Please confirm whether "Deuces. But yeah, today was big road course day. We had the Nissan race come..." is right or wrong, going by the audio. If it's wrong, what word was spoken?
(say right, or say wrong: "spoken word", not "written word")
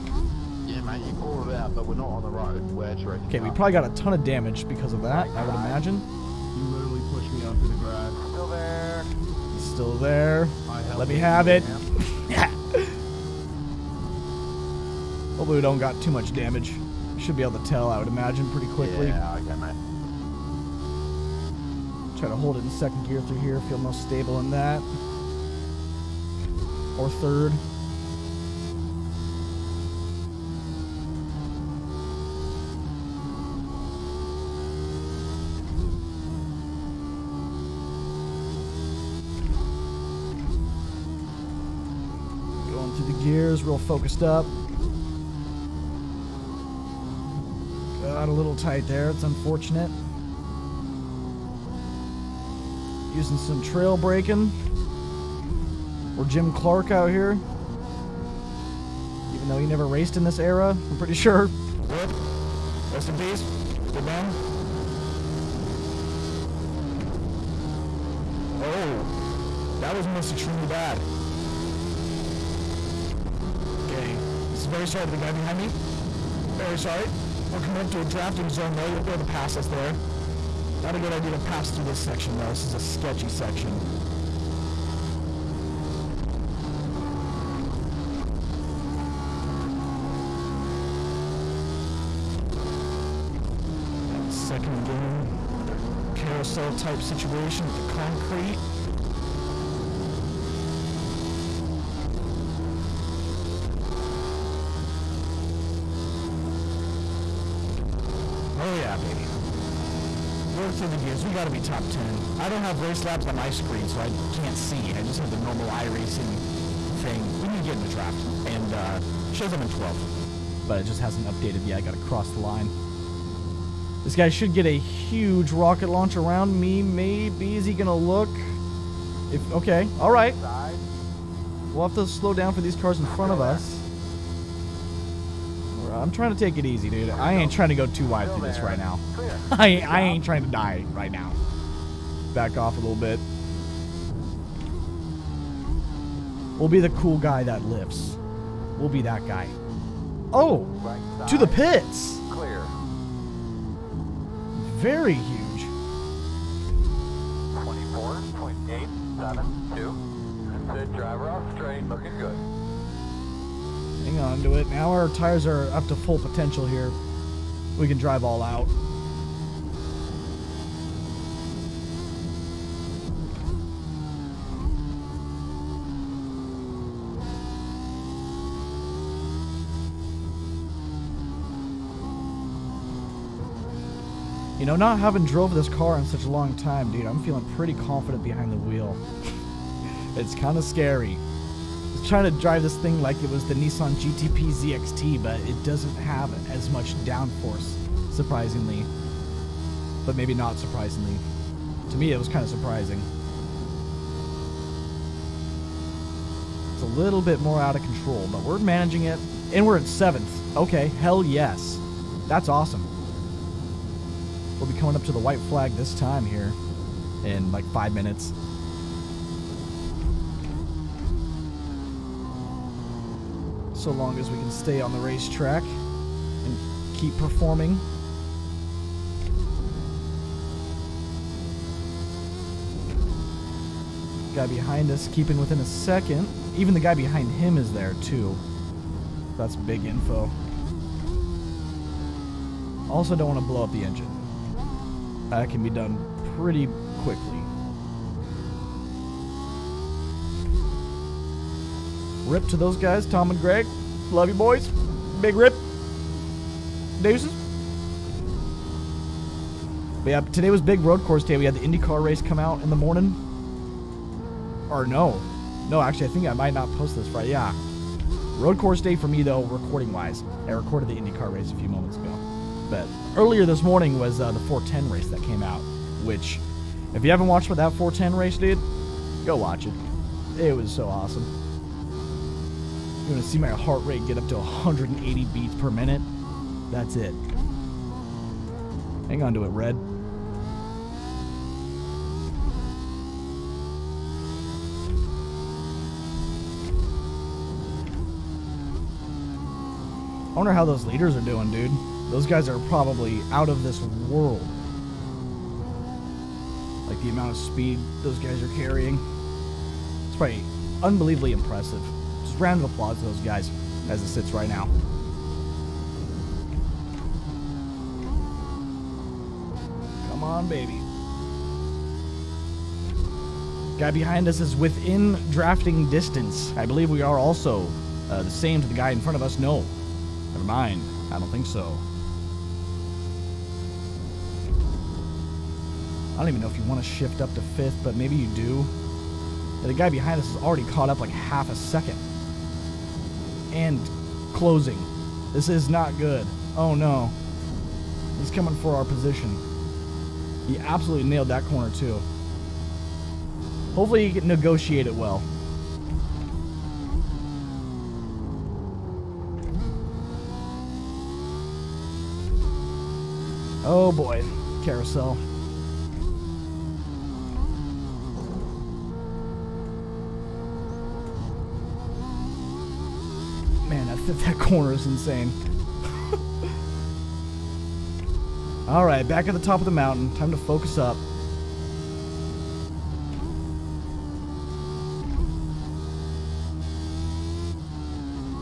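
wrong: "IndyCar", not "Nissan".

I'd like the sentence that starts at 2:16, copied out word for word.
I'm trying to take it easy, dude.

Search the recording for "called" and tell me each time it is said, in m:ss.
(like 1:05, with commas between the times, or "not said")
0:01.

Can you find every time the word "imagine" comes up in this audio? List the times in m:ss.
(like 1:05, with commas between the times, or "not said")
0:05, 0:18.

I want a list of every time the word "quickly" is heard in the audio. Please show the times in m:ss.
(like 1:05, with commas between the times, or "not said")
0:18, 4:07.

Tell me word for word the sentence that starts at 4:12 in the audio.
Rip to those guys, Tom and Greg.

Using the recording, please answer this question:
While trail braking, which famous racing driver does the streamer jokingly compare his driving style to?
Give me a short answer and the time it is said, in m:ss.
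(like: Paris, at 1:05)
Jim Clark, at 0:56.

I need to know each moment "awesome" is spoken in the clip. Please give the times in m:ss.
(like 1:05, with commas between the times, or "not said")
3:32, 4:40.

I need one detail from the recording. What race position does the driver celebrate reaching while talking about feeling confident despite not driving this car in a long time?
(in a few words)
7th.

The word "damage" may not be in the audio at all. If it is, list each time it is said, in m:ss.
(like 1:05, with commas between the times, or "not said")
0:04, 0:16.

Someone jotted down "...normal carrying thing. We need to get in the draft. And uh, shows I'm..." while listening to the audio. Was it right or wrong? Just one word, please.
wrong.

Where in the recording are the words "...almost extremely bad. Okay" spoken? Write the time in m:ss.
1:10.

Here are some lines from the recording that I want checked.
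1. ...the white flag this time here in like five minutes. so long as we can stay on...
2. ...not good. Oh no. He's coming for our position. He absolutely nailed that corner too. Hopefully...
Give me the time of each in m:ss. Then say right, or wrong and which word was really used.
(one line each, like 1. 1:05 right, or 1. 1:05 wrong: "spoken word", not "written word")
1. 3:35 right
2. 5:45 right.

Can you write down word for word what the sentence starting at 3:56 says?
Even the guy behind him is there too.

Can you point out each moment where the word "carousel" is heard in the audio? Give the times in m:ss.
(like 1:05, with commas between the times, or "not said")
1:36, 6:04.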